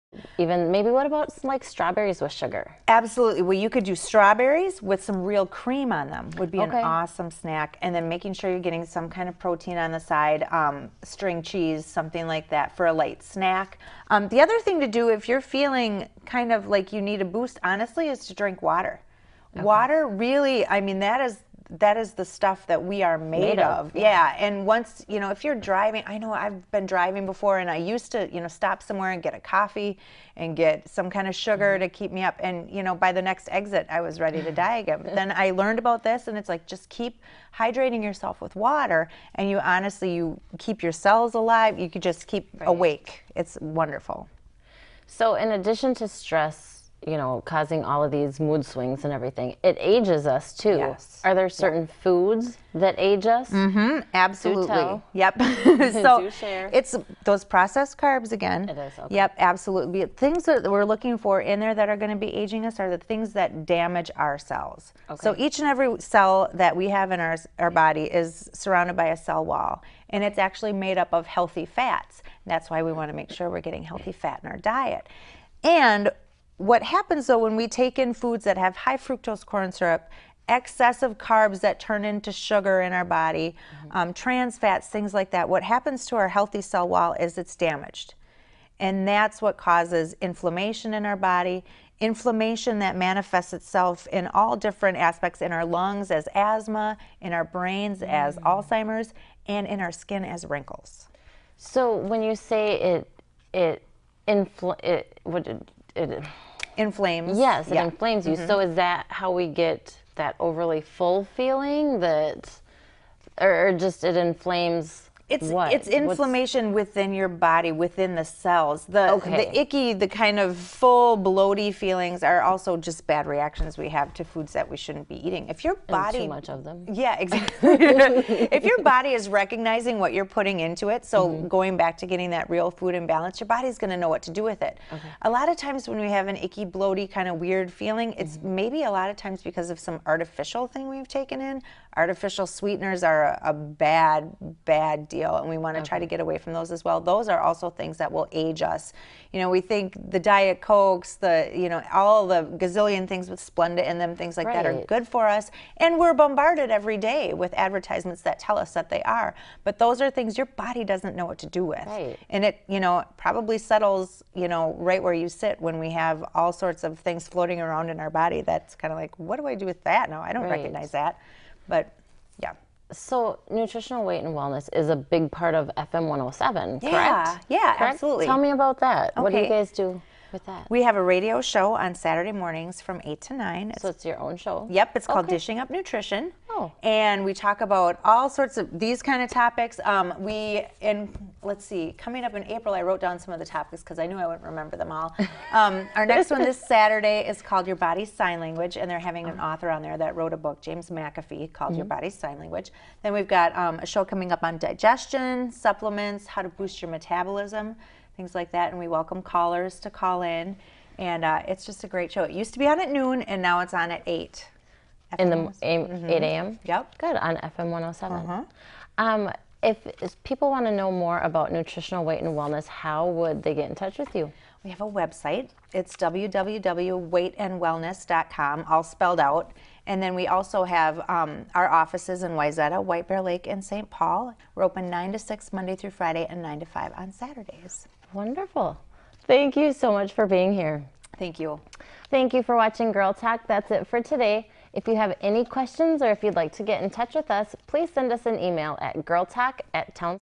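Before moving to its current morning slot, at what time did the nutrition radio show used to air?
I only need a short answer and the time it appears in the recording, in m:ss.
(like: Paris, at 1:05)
Noon, at 3:32.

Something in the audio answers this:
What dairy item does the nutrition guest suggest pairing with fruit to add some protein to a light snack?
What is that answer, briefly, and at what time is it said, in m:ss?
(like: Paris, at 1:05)
String cheese, at 0:11.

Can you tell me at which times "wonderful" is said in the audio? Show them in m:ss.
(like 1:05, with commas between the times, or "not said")
0:43, 3:58.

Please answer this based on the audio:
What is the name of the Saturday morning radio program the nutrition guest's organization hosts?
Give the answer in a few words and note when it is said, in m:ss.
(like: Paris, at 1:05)
Dishing Up Nutrition, at 3:05.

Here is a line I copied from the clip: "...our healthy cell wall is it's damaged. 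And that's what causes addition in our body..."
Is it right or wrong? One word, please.
wrong.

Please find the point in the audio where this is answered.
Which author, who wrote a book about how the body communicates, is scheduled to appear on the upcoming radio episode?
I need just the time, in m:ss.
3:20.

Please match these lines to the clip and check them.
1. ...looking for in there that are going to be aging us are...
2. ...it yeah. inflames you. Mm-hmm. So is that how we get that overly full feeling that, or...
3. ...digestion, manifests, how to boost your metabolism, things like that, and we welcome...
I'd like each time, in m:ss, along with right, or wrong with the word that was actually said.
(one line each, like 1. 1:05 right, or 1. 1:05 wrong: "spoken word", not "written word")
1. 1:00 right
2. 1:47 right
3. 3:24 wrong: "supplements", not "manifests".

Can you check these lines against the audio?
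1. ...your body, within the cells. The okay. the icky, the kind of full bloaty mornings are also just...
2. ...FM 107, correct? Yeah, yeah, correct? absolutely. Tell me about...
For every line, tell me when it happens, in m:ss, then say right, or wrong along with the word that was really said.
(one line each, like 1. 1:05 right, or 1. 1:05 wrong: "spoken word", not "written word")
1. 1:57 wrong: "feelings", not "mornings"
2. 2:55 right.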